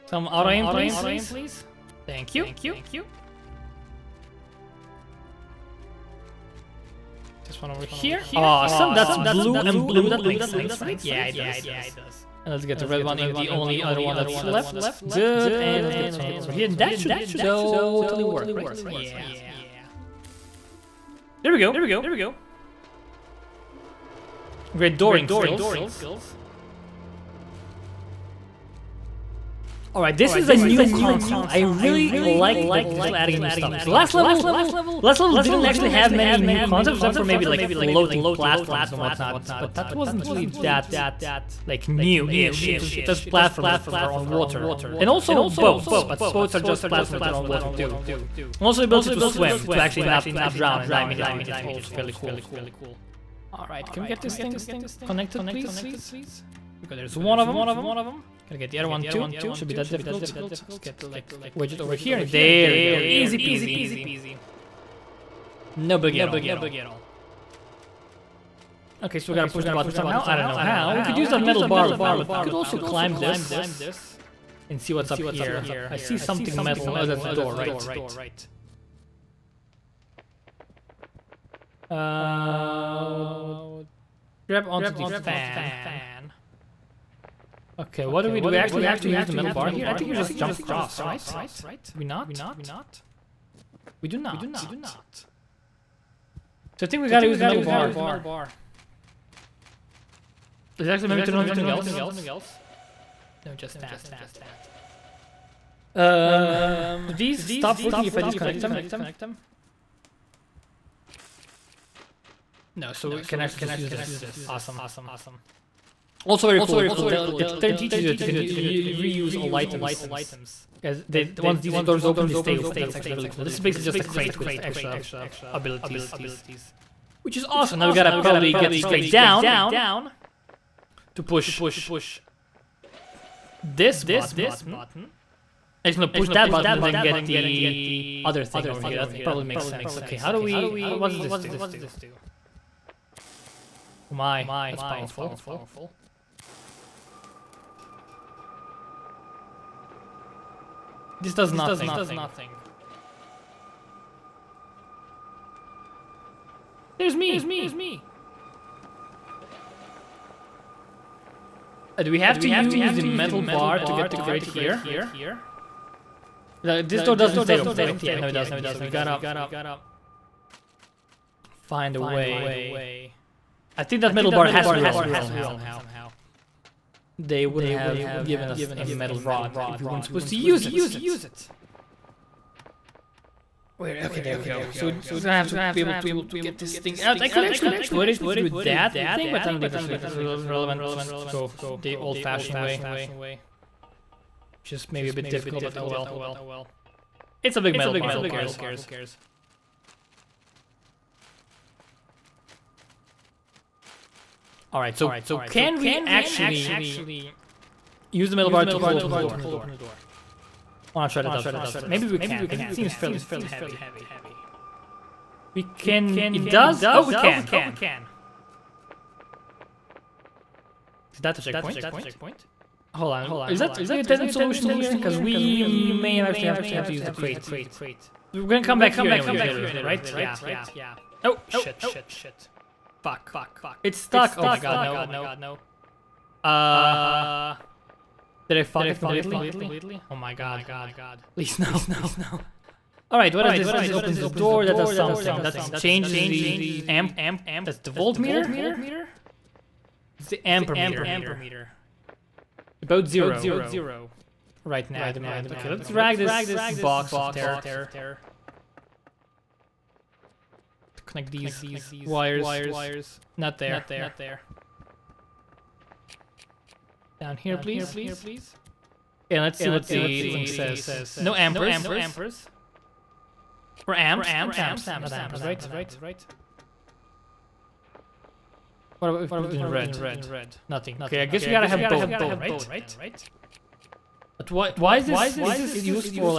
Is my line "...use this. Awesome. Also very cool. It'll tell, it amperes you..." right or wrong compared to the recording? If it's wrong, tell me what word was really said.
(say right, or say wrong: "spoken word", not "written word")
wrong: "teaches", not "amperes".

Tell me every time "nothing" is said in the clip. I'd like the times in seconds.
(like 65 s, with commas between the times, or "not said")
151 s, 280 s.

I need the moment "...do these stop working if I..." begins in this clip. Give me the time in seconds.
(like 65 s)
107 s.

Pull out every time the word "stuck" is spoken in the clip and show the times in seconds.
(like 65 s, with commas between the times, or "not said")
233 s.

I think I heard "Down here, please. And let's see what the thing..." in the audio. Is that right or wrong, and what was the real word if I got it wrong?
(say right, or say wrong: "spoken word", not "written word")
right.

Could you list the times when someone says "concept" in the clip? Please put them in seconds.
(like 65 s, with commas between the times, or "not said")
30 s, 36 s.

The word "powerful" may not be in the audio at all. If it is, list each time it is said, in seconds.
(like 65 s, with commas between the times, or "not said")
144 s.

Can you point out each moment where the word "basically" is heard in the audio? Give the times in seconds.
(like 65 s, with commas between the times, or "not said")
123 s.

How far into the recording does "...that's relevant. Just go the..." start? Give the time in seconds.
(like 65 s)
189 s.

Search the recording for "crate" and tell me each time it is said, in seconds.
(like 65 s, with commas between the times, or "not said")
124 s, 128 s, 164 s, 227 s.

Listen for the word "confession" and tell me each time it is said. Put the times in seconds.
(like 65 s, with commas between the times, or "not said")
not said.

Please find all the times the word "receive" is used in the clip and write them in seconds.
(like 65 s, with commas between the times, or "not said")
not said.